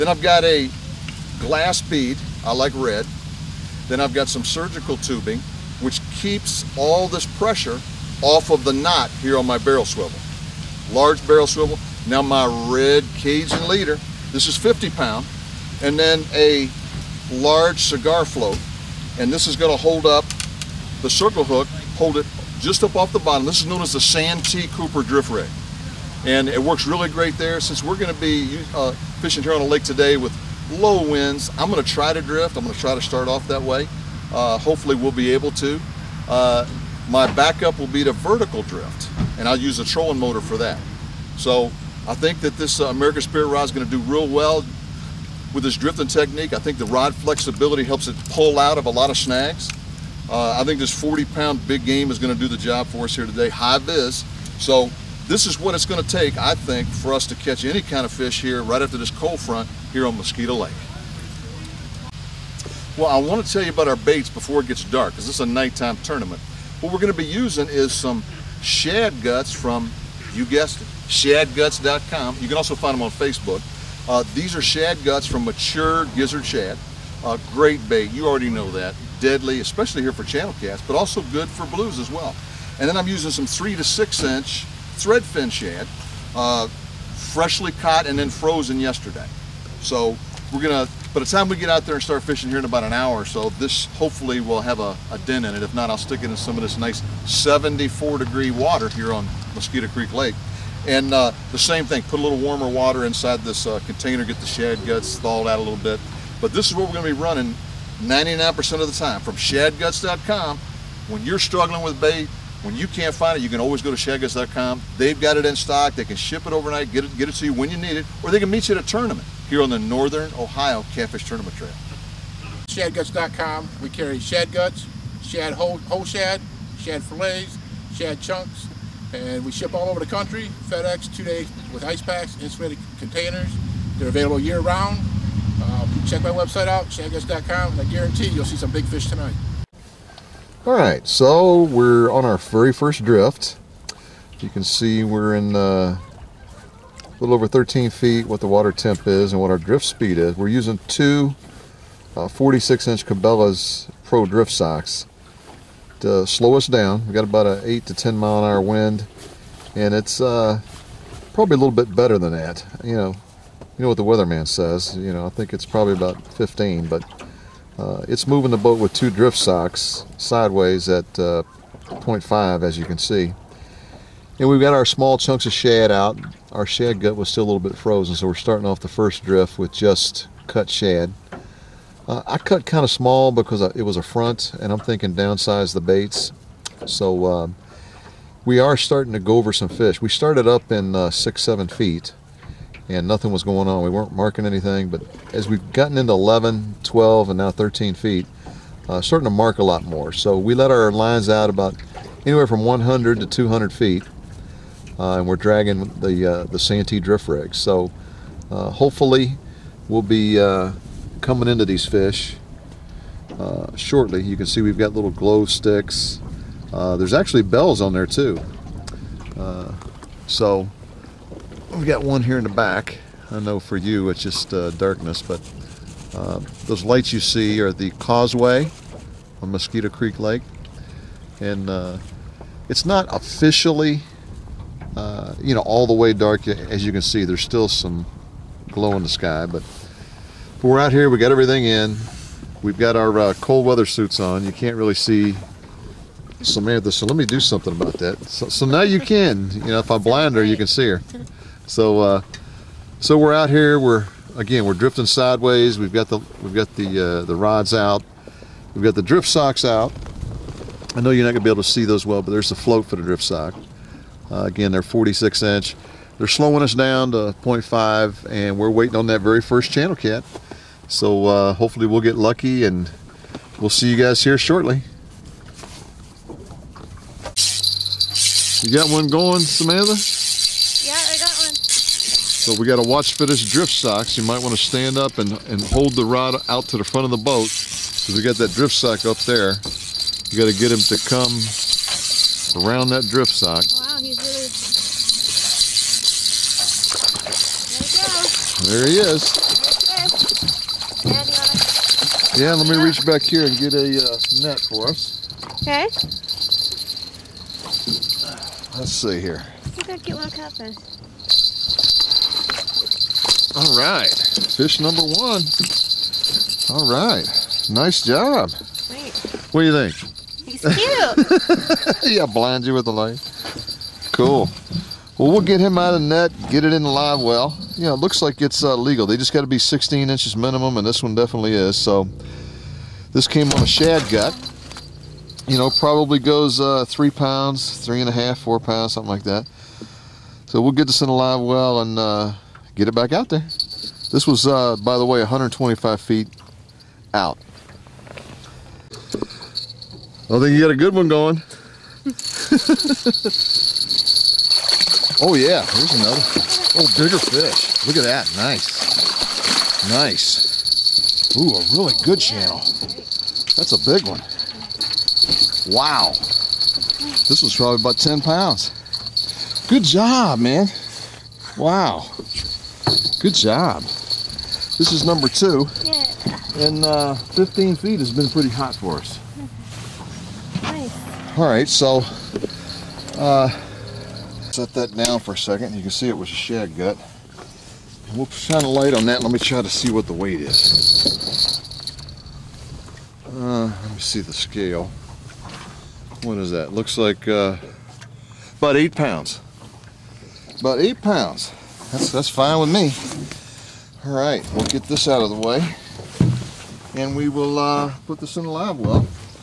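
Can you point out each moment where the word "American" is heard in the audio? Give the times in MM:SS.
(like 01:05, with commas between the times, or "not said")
00:42.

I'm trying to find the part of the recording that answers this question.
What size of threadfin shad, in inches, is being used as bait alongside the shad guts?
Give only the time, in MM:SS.
01:23.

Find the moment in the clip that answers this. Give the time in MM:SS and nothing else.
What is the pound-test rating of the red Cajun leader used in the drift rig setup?
00:14.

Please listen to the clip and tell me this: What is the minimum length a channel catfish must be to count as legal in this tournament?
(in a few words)
16 inches.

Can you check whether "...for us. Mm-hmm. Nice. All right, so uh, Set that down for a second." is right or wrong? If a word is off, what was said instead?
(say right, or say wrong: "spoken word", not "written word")
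right.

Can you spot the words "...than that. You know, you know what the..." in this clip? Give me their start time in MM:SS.
02:42.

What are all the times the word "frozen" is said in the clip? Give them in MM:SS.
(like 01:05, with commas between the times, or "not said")
01:28, 02:57.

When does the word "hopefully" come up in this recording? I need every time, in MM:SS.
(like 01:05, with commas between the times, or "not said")
00:34, 01:33, 03:28, 04:31.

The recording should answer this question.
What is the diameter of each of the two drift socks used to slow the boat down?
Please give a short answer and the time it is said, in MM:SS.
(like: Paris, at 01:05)
46-inch, at 02:32.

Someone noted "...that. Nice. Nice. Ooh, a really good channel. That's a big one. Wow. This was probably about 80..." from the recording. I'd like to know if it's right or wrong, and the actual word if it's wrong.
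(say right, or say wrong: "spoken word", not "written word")
wrong: "10", not "80".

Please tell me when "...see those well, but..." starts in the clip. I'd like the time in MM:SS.
04:21.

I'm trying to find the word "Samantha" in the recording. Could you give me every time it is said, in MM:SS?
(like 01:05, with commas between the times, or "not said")
04:06, 04:39.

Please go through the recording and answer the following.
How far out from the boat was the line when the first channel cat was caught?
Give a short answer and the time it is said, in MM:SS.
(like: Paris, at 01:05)
125 feet, at 05:45.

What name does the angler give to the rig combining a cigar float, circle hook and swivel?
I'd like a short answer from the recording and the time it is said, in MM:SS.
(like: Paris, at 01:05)
Santee Cooper drift rig, at 00:23.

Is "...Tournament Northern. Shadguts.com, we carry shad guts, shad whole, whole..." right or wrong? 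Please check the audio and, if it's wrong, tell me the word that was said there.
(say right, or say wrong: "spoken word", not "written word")
wrong: "Trail", not "Northern".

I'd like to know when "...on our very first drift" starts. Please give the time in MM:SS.
02:22.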